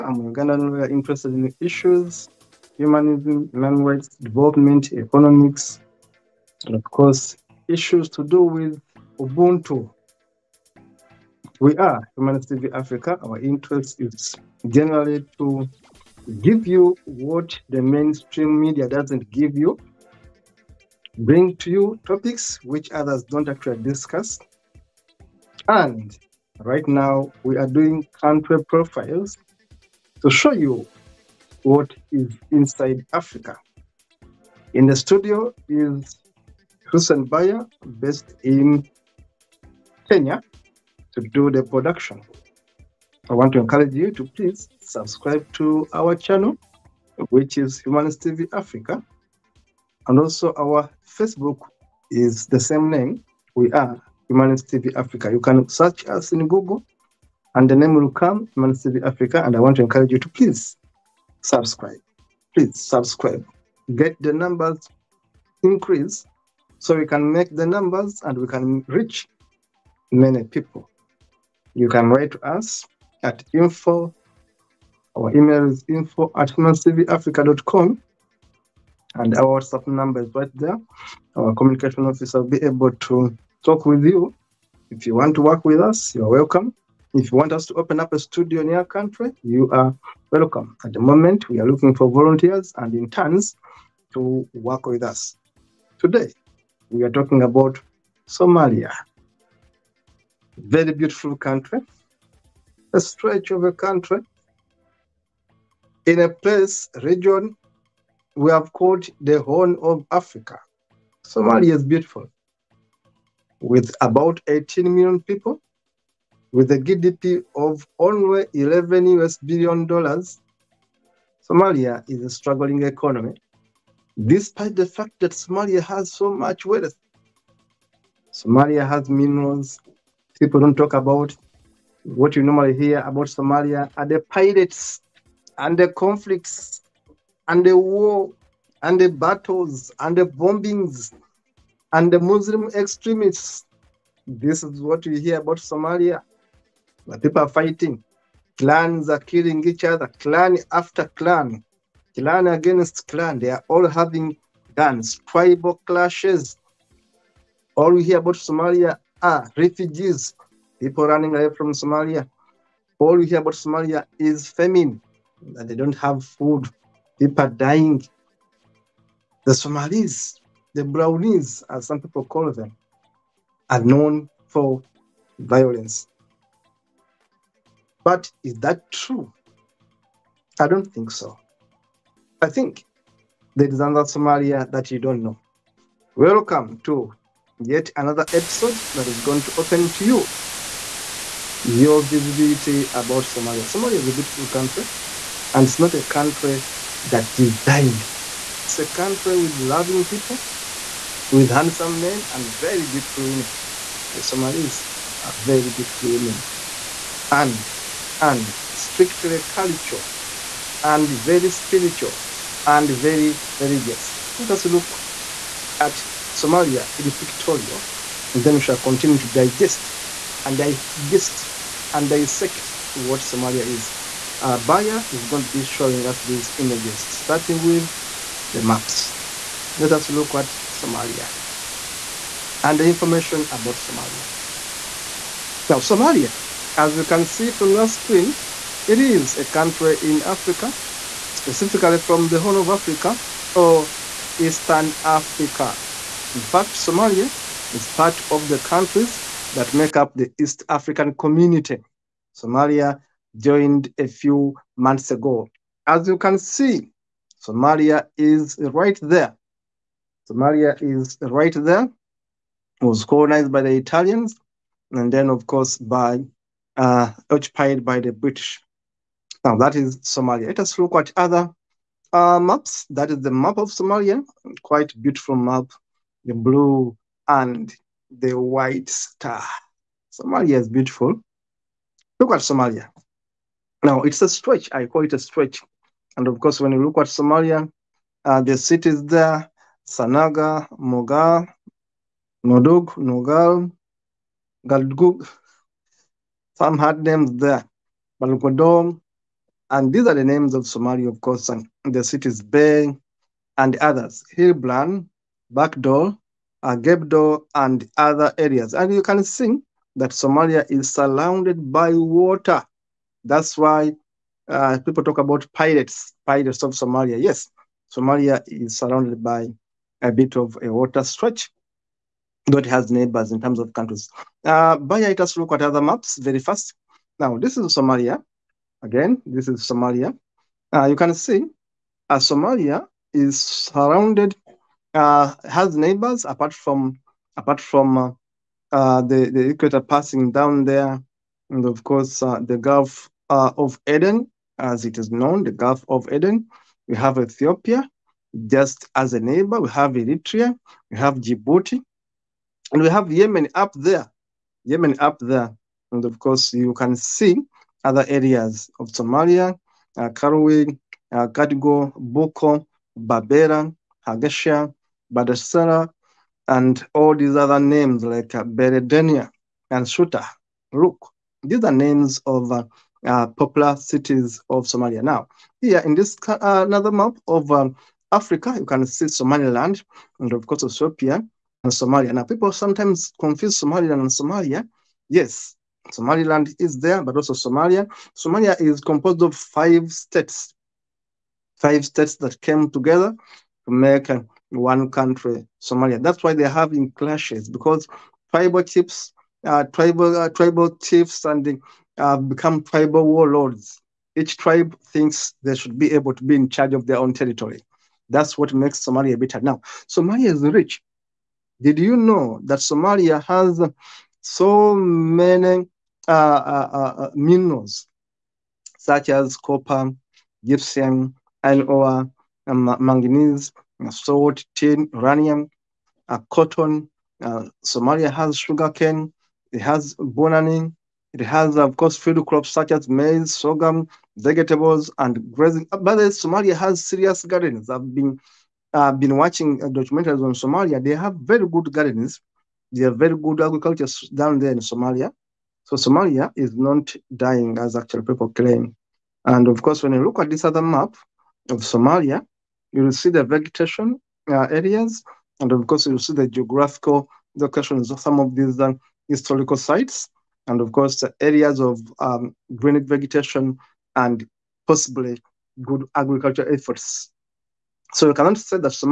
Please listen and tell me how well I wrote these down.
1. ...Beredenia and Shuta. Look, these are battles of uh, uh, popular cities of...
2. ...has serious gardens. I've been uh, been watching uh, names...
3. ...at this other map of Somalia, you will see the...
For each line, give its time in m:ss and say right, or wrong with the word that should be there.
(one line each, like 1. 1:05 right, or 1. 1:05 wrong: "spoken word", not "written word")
1. 6:08 wrong: "names", not "battles"
2. 7:16 wrong: "documentaries", not "names"
3. 7:30 right.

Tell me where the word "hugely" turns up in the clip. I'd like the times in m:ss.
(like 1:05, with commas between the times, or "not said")
not said.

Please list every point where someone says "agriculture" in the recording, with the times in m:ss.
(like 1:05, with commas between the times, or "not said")
7:23, 7:45.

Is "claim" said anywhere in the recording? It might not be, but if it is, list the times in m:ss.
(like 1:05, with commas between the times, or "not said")
7:28.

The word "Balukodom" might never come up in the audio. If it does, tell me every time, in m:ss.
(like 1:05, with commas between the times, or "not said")
4:58.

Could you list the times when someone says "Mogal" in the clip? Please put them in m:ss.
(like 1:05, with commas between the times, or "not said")
4:50.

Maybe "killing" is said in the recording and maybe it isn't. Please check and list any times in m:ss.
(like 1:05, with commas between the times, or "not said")
2:29.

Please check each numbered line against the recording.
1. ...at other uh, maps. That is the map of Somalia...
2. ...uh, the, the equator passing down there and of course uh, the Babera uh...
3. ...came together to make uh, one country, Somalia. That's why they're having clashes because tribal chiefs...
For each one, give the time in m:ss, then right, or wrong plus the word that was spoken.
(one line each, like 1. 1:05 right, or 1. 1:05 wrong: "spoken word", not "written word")
1. 4:30 right
2. 5:38 wrong: "Gulf", not "Babera"
3. 6:32 right.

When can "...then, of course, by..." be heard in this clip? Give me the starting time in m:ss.
4:25.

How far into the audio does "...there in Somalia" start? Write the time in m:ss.
7:24.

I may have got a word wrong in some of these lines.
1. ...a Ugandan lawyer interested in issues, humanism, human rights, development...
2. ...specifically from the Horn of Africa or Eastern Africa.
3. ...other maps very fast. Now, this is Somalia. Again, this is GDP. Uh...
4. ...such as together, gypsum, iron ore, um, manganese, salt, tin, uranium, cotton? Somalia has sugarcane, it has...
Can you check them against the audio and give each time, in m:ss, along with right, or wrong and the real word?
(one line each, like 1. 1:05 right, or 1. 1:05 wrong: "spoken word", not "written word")
1. 0:00 right
2. 4:01 right
3. 5:25 wrong: "Somalia", not "GDP"
4. 6:58 wrong: "copper", not "together".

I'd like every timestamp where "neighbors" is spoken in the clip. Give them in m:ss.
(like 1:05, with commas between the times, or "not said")
5:22, 5:35, 5:49.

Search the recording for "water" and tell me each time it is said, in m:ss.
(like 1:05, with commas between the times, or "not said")
5:11, 5:20.